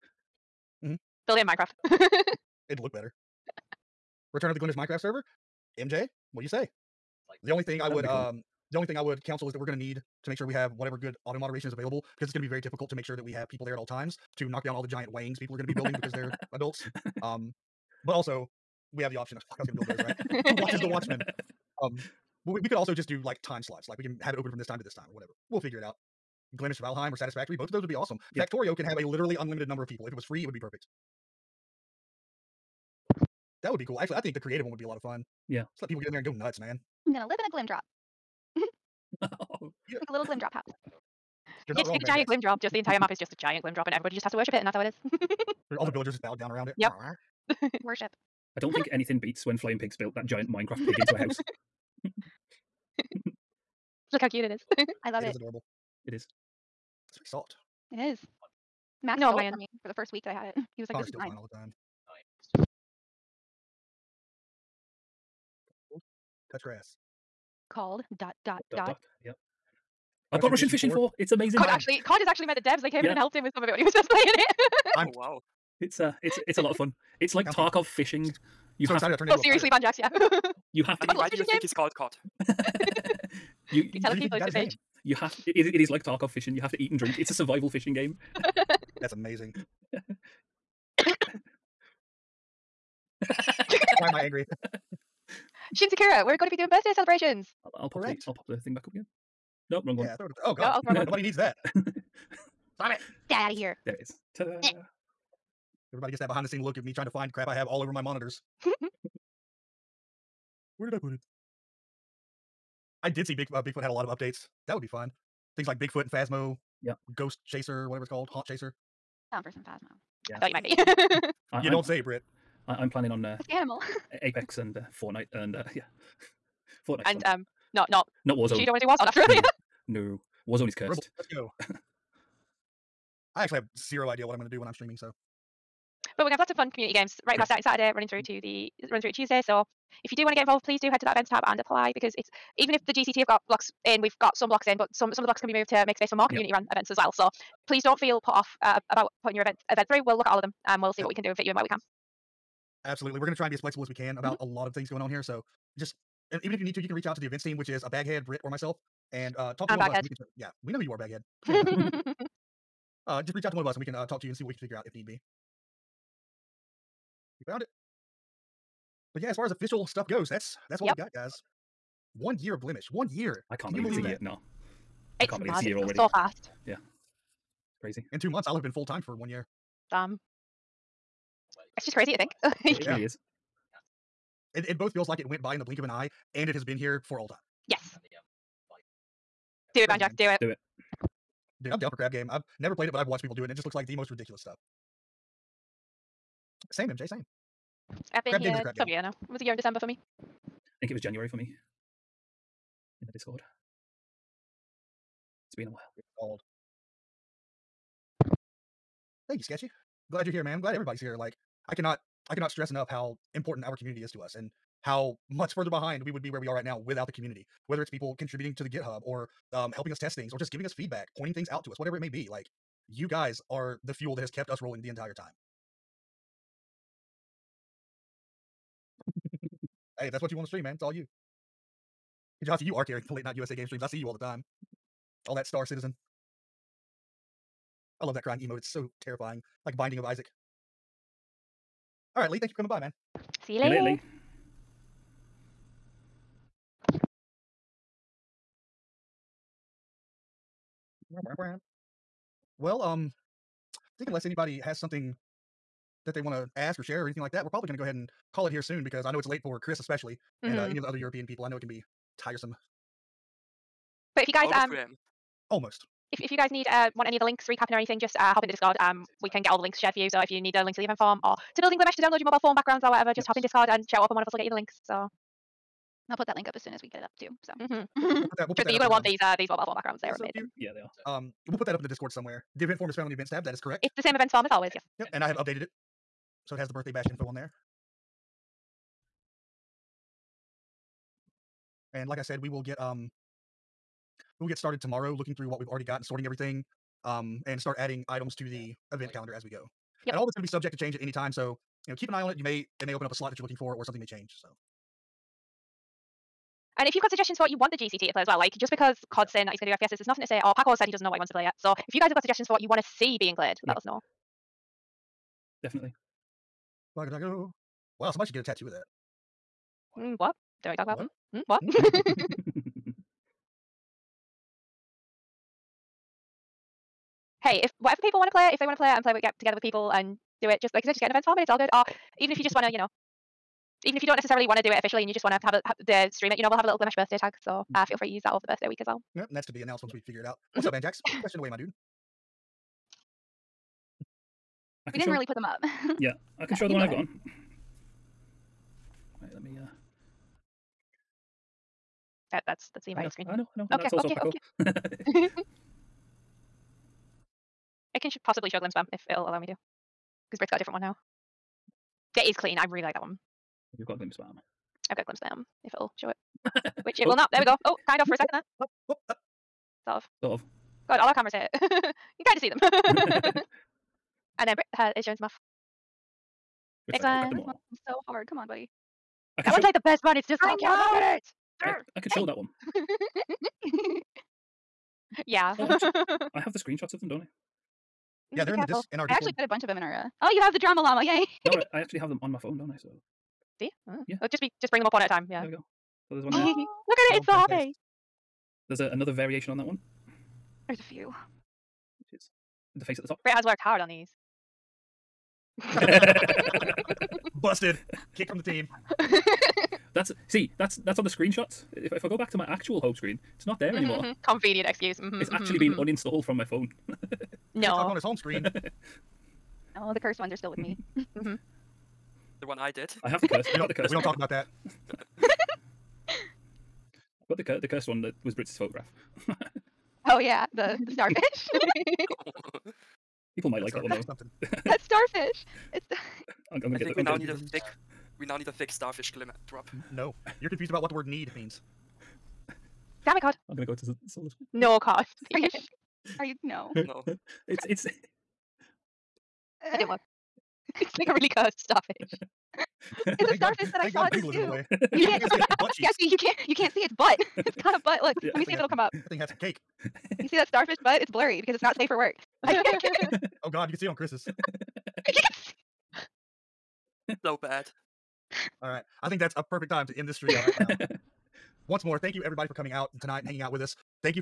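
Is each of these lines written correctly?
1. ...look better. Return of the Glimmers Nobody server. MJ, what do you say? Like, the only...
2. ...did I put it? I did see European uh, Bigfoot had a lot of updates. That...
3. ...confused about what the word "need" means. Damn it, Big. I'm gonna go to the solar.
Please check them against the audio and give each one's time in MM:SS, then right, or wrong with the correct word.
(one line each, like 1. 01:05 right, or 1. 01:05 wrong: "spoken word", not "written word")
1. 00:02 wrong: "Minecraft", not "Nobody"
2. 01:50 wrong: "Big", not "European"
3. 07:20 wrong: "God", not "Big".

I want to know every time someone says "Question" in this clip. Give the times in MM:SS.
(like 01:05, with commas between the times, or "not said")
05:41.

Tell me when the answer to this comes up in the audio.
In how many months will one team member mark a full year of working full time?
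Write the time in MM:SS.
02:58.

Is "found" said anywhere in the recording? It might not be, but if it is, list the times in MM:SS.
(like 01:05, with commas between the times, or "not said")
02:47, 04:42.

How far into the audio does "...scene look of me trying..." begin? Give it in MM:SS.
01:46.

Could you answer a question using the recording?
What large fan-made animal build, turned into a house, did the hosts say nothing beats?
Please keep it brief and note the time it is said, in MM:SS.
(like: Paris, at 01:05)
giant Minecraft pig, at 00:50.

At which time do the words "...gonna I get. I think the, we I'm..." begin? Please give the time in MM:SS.
07:16.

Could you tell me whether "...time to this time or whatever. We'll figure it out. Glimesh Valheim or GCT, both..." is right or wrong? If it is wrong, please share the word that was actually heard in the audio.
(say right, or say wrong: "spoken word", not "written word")
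wrong: "Satisfactory", not "GCT".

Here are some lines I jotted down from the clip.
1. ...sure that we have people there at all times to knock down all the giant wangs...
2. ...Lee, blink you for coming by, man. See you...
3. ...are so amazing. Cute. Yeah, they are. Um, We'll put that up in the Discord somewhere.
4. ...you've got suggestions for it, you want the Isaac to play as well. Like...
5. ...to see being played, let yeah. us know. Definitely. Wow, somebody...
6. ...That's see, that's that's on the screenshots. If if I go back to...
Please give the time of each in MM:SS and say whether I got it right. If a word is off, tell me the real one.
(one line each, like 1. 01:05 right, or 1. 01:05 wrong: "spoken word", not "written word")
1. 00:13 right
2. 04:02 wrong: "thank", not "blink"
3. 04:40 right
4. 05:06 wrong: "GCT", not "Isaac"
5. 05:12 right
6. 06:49 right.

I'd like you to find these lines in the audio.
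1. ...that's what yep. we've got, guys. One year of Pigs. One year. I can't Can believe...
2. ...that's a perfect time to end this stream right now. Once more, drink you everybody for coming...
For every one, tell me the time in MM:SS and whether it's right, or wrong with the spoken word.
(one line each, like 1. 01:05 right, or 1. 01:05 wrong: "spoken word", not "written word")
1. 02:50 wrong: "Glimesh", not "Pigs"
2. 07:49 wrong: "thank", not "drink".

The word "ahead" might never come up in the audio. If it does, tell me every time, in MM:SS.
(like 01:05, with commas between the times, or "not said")
04:17, 05:46.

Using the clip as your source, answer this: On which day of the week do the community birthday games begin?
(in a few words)
Saturday.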